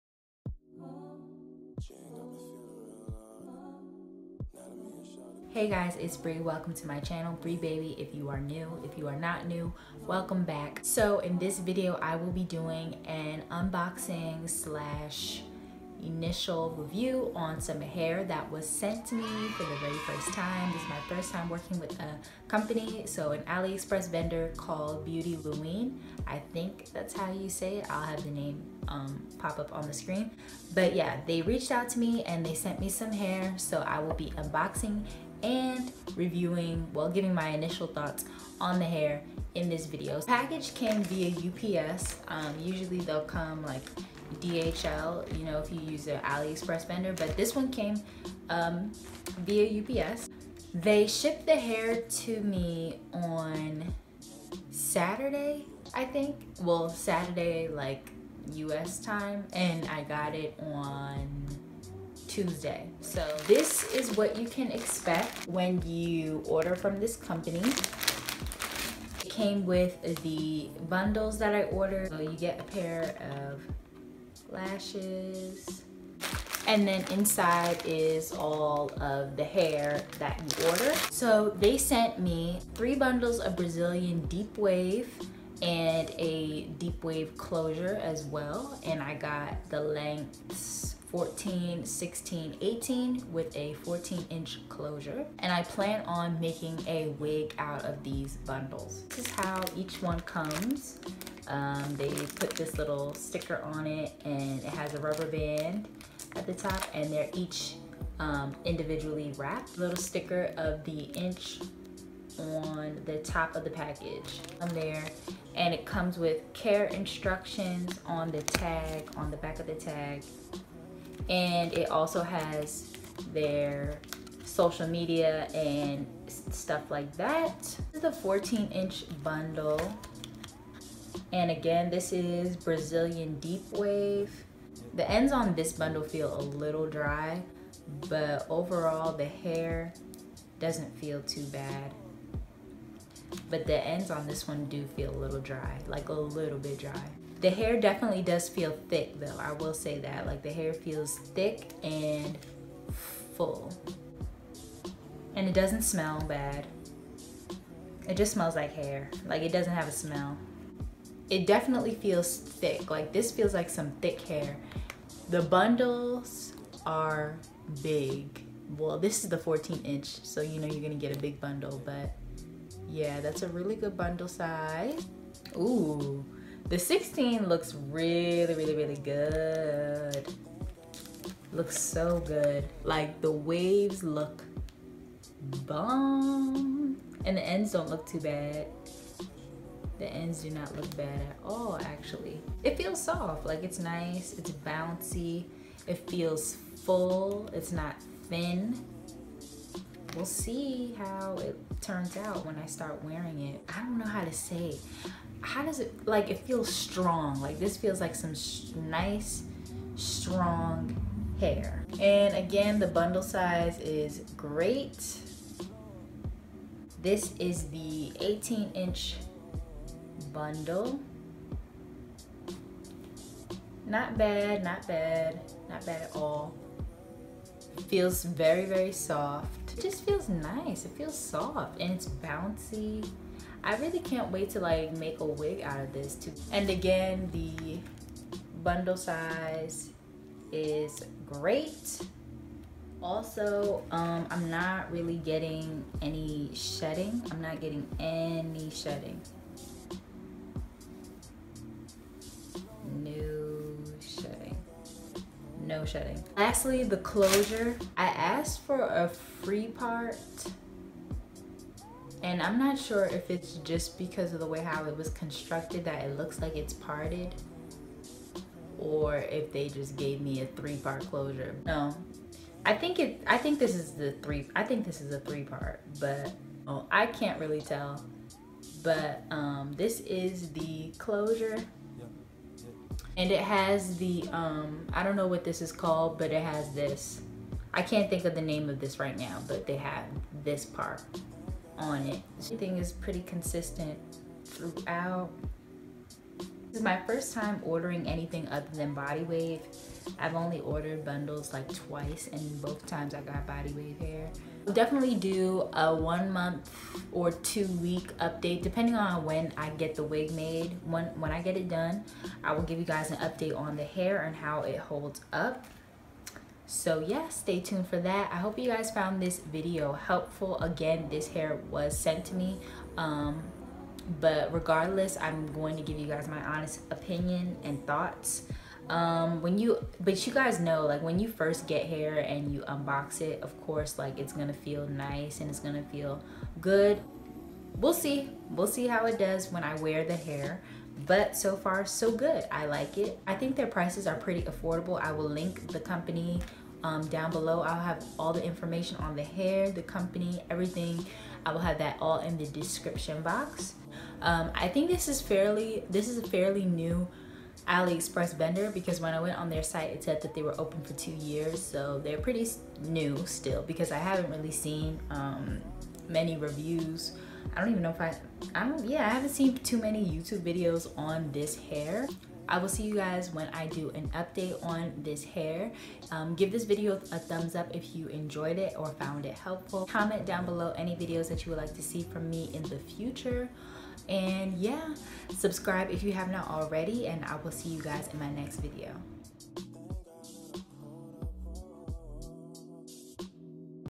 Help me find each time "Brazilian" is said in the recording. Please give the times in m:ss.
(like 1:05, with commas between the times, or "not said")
1:23, 2:12.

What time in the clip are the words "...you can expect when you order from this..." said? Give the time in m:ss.
1:04.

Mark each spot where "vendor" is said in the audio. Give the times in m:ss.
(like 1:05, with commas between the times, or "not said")
0:24, 0:46, 5:58.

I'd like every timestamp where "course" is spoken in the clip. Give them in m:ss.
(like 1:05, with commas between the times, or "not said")
5:33.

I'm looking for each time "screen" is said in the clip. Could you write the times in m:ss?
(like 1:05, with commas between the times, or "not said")
0:29.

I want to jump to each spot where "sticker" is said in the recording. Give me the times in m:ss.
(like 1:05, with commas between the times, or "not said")
1:43, 1:49.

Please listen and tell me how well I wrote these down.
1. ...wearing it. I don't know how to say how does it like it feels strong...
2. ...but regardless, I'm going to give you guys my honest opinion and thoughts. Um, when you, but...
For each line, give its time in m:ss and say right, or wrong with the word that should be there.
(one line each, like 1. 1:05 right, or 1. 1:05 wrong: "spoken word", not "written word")
1. 3:23 right
2. 5:24 right.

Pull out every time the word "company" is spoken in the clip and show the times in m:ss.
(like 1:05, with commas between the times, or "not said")
0:22, 1:07, 5:45, 5:49.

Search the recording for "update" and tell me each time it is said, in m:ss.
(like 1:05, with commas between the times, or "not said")
5:08, 5:13, 6:14.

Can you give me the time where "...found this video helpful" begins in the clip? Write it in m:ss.
5:18.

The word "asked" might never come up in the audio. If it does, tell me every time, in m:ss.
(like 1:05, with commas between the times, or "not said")
4:18.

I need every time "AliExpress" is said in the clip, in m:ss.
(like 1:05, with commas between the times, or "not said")
0:23, 0:46, 5:57.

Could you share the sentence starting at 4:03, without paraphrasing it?
Also, um, I'm not really getting any shedding.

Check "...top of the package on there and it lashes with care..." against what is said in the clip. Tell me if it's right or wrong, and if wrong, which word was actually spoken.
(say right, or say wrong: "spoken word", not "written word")
wrong: "comes", not "lashes".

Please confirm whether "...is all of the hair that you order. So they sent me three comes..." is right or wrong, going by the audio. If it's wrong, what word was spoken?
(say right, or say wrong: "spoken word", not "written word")
wrong: "bundles", not "comes".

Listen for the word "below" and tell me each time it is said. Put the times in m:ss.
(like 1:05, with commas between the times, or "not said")
5:47, 6:20.